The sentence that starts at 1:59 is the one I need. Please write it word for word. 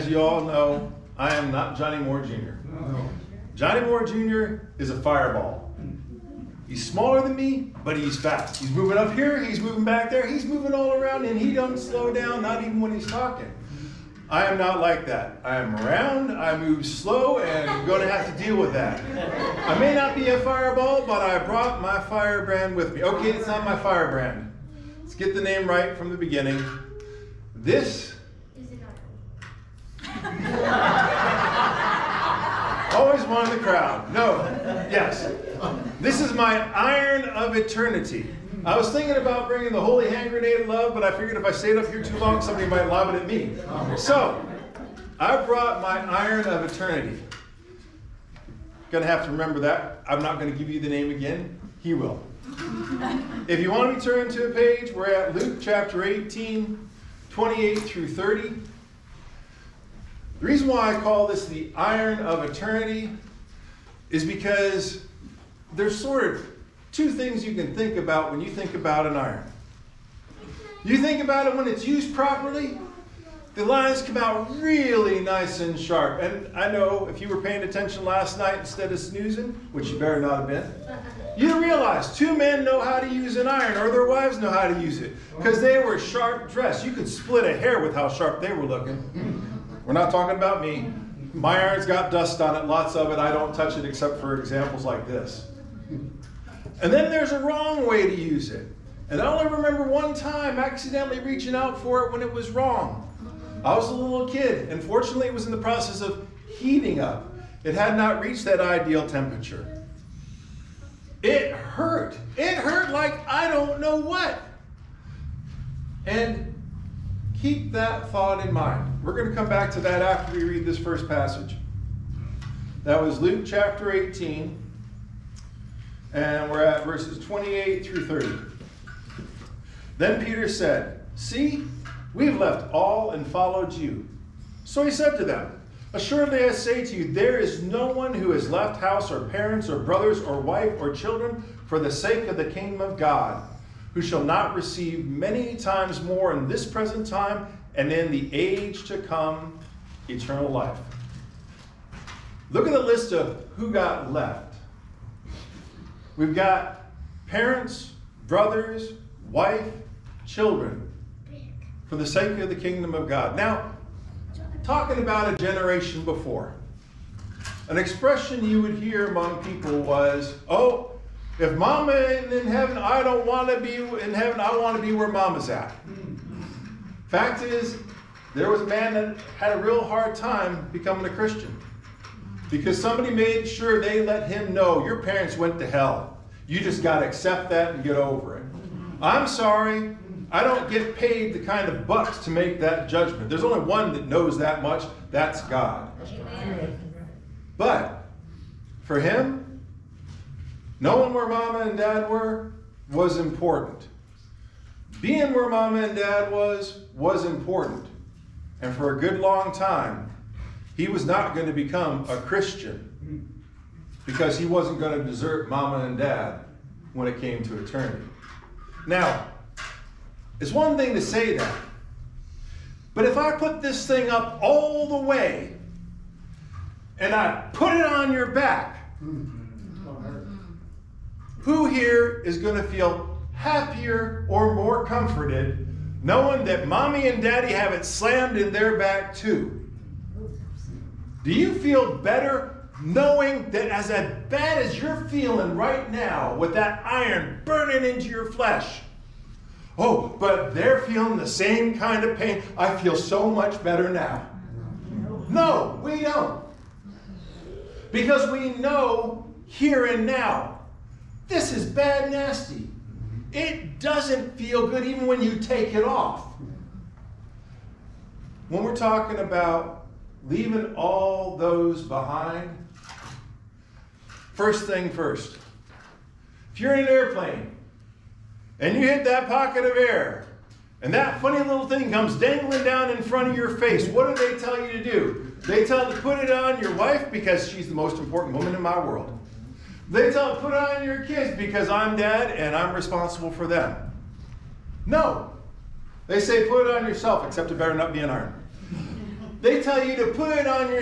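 We're going to come back to that after we read this first passage.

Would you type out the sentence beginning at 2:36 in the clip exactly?
We've got parents, brothers, wife, children for the sake of the kingdom of God.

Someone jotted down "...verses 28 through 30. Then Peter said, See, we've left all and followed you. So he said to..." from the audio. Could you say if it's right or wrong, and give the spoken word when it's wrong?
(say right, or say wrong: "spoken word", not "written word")
right.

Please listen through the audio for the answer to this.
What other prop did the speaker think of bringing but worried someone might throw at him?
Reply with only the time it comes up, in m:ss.
0:39.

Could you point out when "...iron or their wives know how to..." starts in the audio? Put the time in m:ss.
1:23.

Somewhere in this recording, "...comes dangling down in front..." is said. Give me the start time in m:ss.
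4:41.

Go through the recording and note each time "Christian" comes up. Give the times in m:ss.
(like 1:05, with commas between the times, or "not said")
3:01, 3:32.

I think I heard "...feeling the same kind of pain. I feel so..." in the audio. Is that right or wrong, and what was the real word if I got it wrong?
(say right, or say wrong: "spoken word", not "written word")
right.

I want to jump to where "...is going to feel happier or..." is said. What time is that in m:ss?
3:52.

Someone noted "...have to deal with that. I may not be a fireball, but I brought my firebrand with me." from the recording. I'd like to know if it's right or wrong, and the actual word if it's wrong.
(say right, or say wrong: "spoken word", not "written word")
right.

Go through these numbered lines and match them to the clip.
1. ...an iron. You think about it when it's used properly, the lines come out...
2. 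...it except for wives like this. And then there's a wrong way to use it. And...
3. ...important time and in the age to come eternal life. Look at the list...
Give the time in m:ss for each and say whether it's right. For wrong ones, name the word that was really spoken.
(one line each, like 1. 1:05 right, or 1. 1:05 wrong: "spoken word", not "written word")
1. 1:09 right
2. 1:33 wrong: "examples", not "wives"
3. 2:26 wrong: "present", not "important".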